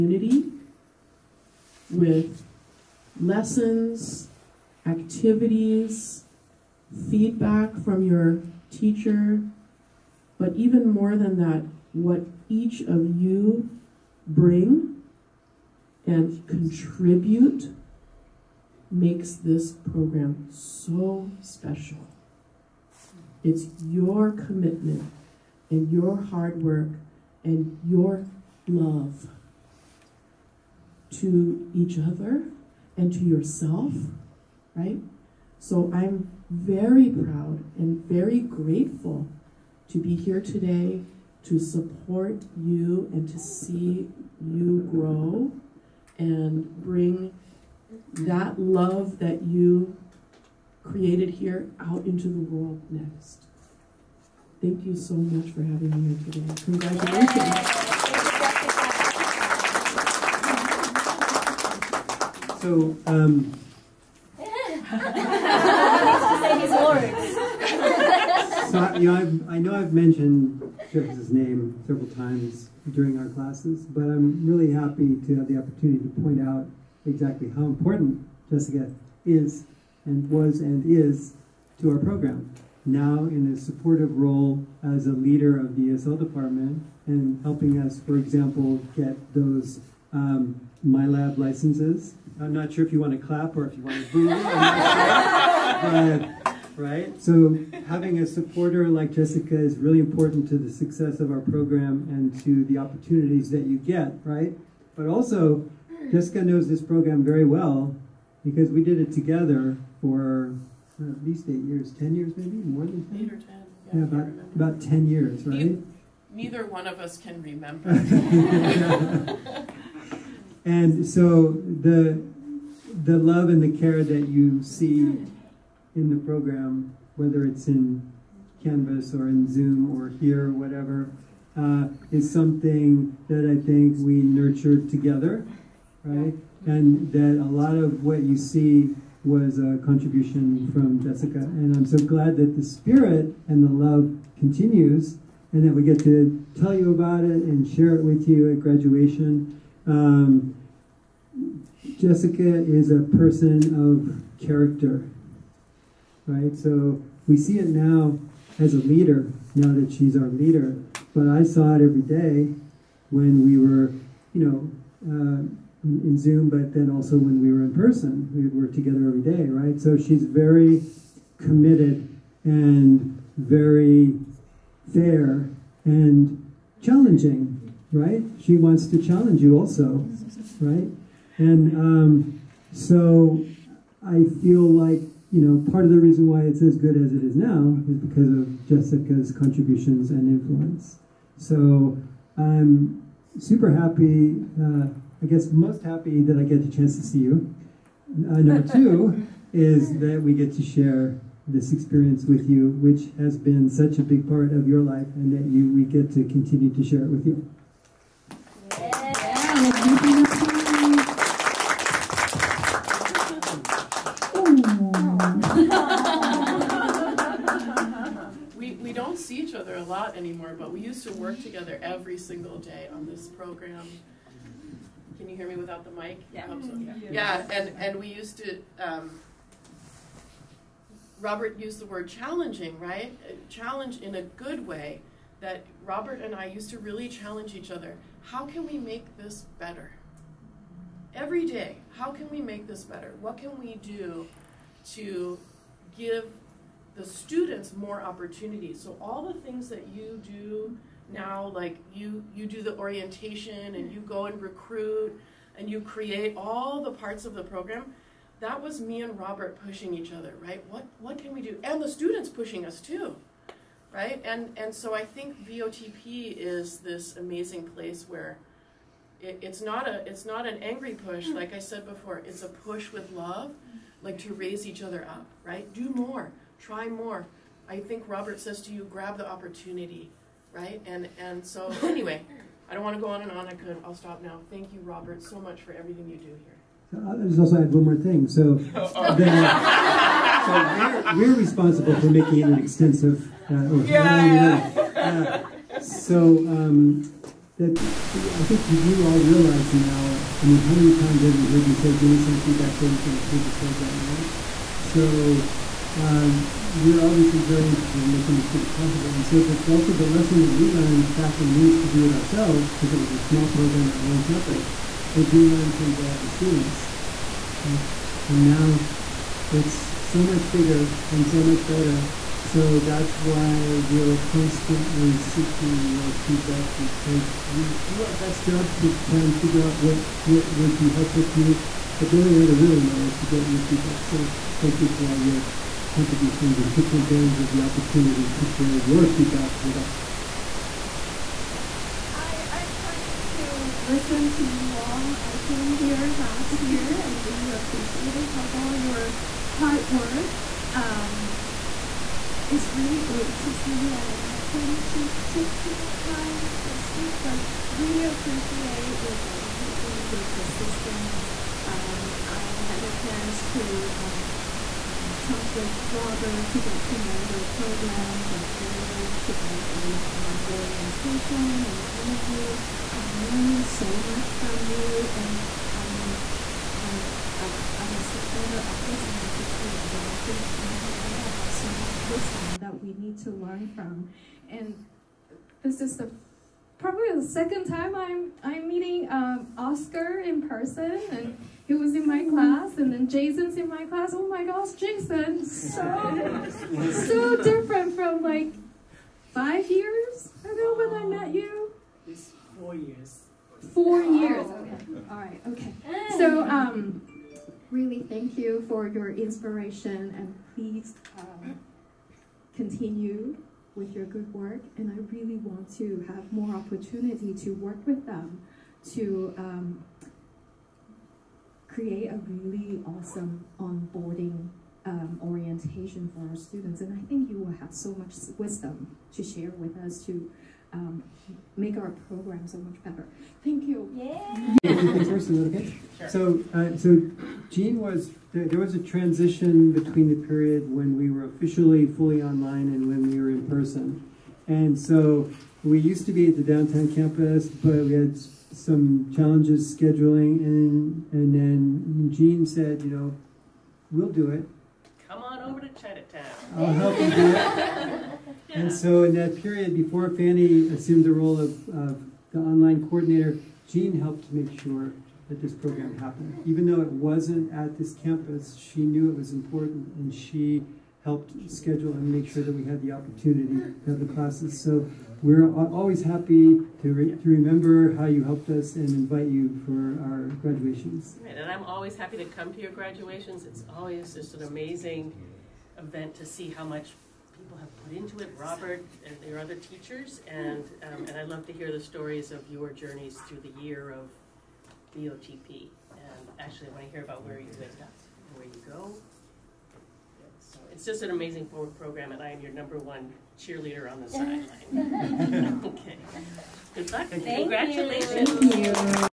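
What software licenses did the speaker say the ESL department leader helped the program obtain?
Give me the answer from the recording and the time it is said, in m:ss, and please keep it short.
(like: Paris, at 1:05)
MyLab, at 1:30.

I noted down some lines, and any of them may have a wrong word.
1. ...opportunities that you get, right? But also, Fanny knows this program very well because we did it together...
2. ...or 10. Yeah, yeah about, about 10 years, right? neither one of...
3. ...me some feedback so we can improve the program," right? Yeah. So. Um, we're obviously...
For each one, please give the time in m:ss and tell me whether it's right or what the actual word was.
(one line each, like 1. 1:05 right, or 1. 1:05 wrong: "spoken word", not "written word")
1. 1:42 wrong: "Jessica", not "Fanny"
2. 1:53 right
3. 5:02 right.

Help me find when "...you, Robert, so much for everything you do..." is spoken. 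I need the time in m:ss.
4:44.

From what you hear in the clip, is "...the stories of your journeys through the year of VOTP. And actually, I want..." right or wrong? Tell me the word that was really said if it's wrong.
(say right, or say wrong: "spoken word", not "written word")
right.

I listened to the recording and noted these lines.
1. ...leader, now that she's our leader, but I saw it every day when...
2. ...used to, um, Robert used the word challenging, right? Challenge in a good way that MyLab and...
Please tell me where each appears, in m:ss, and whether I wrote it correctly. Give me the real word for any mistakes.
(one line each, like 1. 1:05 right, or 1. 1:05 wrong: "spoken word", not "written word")
1. 2:38 right
2. 3:48 wrong: "Robert", not "MyLab".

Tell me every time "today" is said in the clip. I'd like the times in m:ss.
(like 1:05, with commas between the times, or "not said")
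0:40, 0:56.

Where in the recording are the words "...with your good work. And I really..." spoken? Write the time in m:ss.
6:53.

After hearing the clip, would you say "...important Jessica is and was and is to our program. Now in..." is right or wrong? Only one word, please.
right.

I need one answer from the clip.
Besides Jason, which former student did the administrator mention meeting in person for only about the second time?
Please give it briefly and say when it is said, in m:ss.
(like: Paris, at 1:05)
Oscar, at 6:29.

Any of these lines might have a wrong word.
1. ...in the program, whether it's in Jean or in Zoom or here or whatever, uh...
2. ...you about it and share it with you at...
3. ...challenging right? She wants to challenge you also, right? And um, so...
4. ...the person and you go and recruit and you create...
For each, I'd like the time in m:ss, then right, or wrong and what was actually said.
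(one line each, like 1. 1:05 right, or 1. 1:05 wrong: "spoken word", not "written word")
1. 2:05 wrong: "Canvas", not "Jean"
2. 2:26 right
3. 2:56 right
4. 4:12 wrong: "orientation", not "person".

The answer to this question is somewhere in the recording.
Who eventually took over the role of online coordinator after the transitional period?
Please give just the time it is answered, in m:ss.
7:40.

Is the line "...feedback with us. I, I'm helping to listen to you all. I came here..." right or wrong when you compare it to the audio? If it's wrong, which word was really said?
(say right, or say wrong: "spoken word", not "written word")
wrong: "planning", not "helping".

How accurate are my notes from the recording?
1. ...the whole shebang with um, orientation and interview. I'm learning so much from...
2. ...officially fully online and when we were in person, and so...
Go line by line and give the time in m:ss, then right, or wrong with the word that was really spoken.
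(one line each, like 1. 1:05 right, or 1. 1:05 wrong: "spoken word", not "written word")
1. 6:08 right
2. 7:21 right.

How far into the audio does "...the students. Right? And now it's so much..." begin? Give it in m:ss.
5:16.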